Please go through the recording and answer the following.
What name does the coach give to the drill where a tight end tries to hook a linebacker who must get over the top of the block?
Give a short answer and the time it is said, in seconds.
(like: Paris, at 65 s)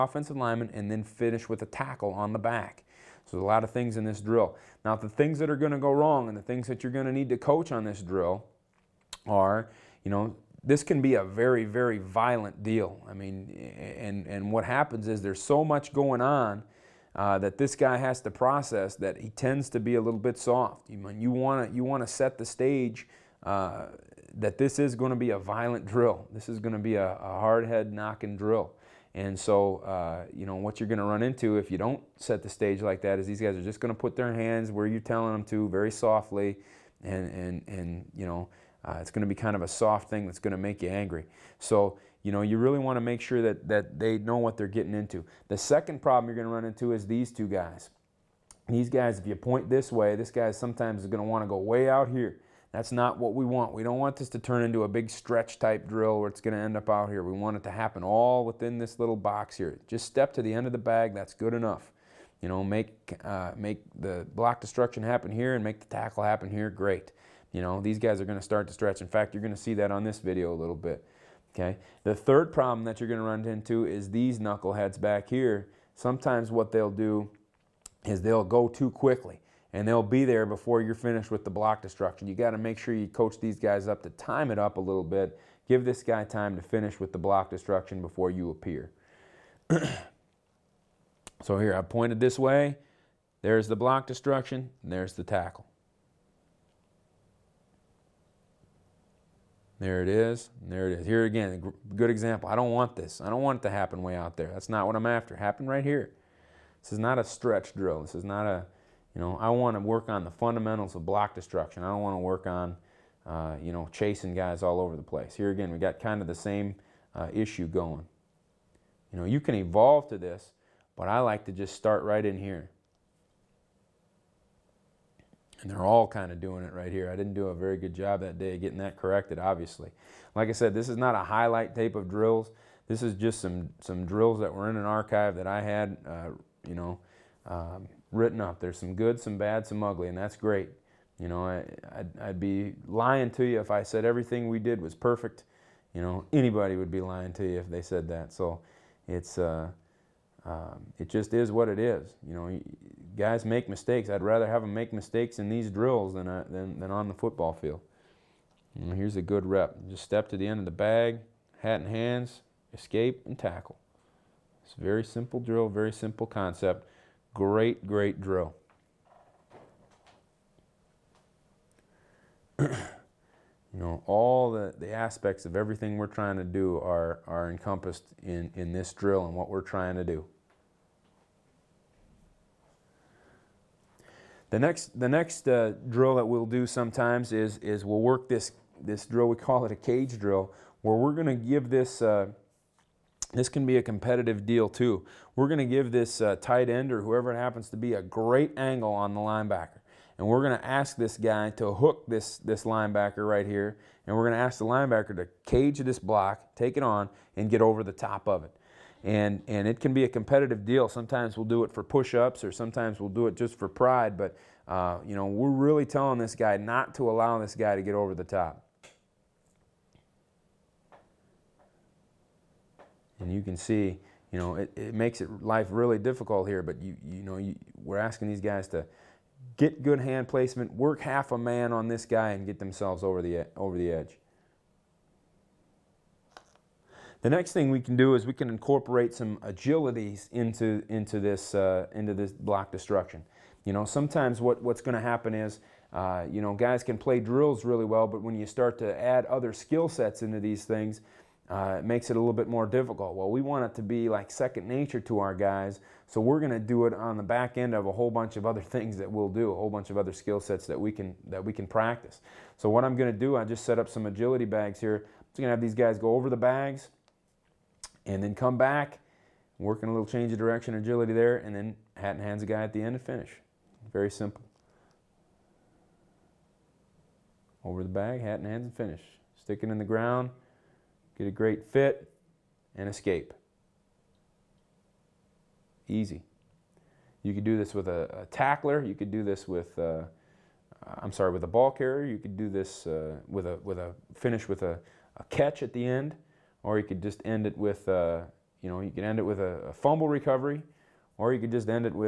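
Cage drill, at 189 s.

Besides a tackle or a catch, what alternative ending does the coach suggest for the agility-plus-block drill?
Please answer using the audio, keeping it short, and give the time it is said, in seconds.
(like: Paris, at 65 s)
Fumble recovery, at 299 s.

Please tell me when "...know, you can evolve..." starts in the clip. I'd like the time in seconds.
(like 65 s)
119 s.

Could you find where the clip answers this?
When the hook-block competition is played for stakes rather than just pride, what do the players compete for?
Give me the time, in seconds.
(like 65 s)
211 s.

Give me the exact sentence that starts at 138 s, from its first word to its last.
There's some good, some bad, some ugly, and that's great.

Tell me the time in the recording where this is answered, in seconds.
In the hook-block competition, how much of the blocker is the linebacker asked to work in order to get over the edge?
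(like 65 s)
231 s.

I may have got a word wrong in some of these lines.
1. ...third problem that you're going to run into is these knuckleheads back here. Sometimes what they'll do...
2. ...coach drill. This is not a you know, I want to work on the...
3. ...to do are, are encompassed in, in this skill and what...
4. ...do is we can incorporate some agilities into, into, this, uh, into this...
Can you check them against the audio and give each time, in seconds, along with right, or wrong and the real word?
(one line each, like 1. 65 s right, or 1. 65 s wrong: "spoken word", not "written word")
1. 72 s right
2. 107 s wrong: "stretch", not "coach"
3. 176 s wrong: "drill", not "skill"
4. 237 s right.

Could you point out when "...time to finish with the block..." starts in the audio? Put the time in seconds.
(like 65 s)
86 s.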